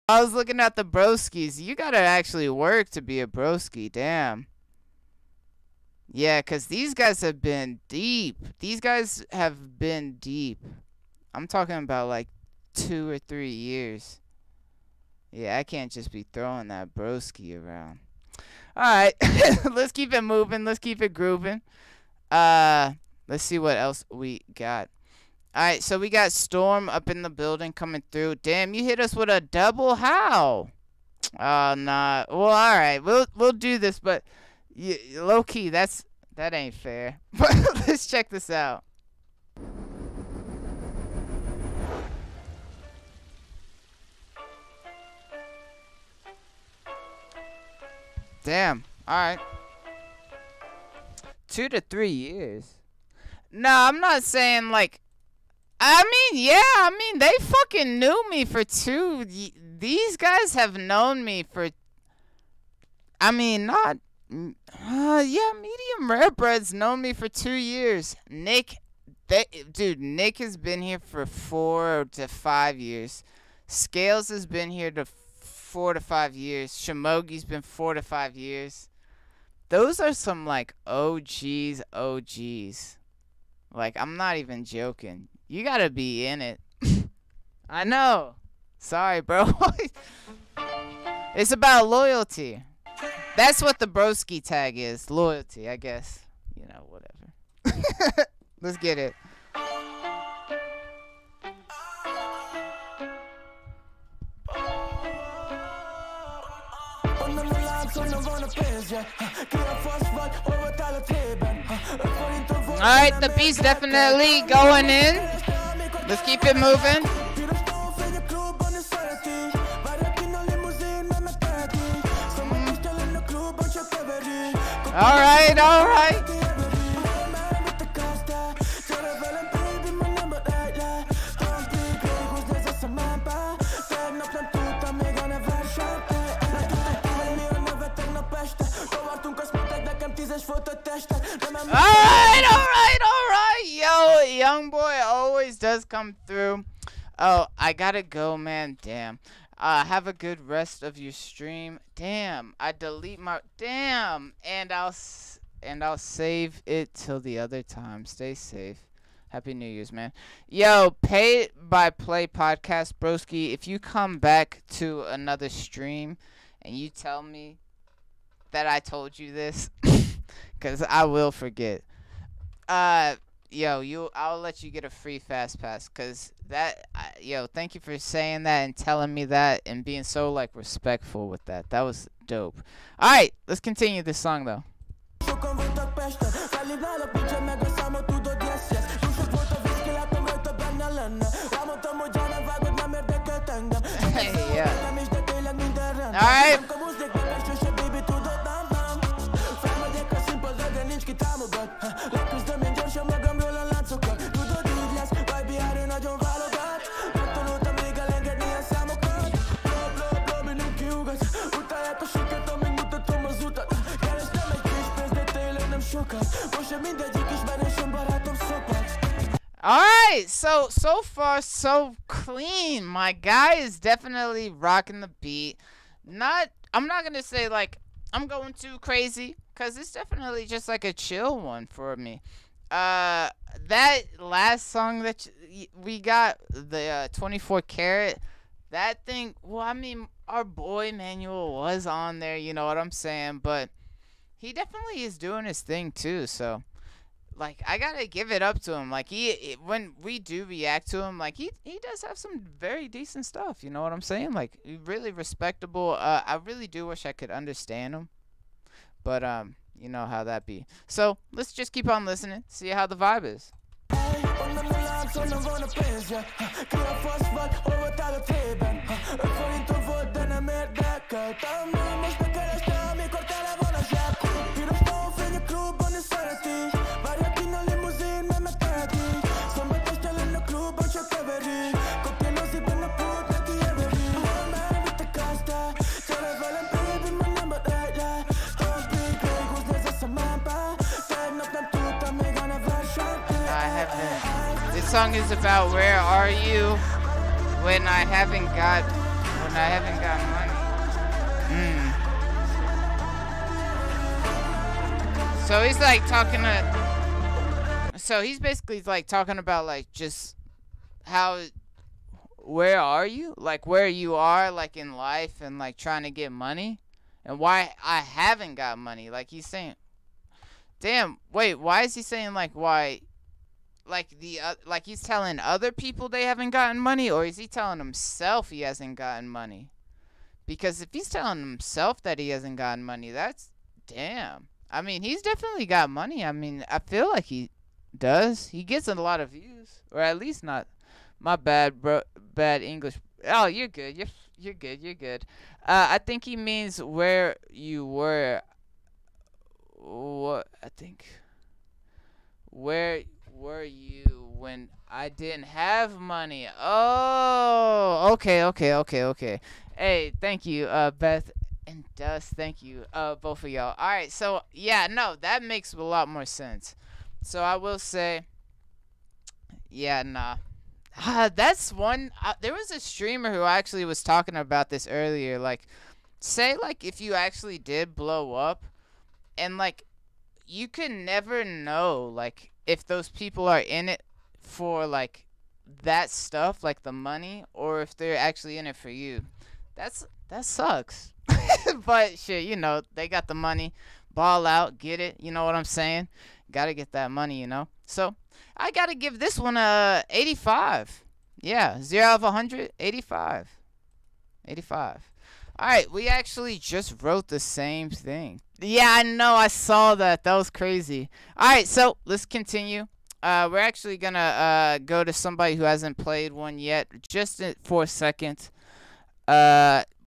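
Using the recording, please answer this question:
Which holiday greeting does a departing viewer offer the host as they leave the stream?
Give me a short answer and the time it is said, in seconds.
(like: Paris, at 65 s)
Happy New Year's, at 159 s.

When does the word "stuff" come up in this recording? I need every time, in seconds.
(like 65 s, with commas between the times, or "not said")
253 s, 386 s.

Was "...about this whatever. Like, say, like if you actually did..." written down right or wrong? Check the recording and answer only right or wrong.
wrong.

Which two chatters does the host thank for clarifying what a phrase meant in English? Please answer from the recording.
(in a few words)
Beth and Dust.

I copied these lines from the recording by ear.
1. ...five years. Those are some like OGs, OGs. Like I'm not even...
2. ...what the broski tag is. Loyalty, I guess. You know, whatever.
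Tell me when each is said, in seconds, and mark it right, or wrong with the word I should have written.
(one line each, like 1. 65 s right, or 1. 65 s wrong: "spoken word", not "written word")
1. 78 s right
2. 93 s right.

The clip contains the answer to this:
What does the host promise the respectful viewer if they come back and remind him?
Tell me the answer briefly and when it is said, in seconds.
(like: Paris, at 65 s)
Free fast pass, at 174 s.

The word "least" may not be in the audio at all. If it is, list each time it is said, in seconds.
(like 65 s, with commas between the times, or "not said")
340 s.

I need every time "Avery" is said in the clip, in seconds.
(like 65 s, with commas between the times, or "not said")
not said.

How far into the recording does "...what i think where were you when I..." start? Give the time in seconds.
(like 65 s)
349 s.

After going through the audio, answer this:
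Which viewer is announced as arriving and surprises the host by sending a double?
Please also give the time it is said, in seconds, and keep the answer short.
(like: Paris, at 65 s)
Storm, at 26 s.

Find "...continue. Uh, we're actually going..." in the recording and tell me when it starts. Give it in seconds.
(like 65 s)
412 s.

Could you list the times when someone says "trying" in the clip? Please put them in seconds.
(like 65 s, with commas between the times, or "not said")
315 s.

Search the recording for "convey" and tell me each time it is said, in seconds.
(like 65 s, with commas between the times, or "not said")
not said.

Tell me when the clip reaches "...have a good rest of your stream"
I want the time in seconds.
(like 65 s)
149 s.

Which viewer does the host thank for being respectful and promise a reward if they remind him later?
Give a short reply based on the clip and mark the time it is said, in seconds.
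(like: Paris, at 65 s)
Pay by play podcast, at 161 s.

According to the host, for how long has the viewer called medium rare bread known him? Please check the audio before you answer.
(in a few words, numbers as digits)
2 years.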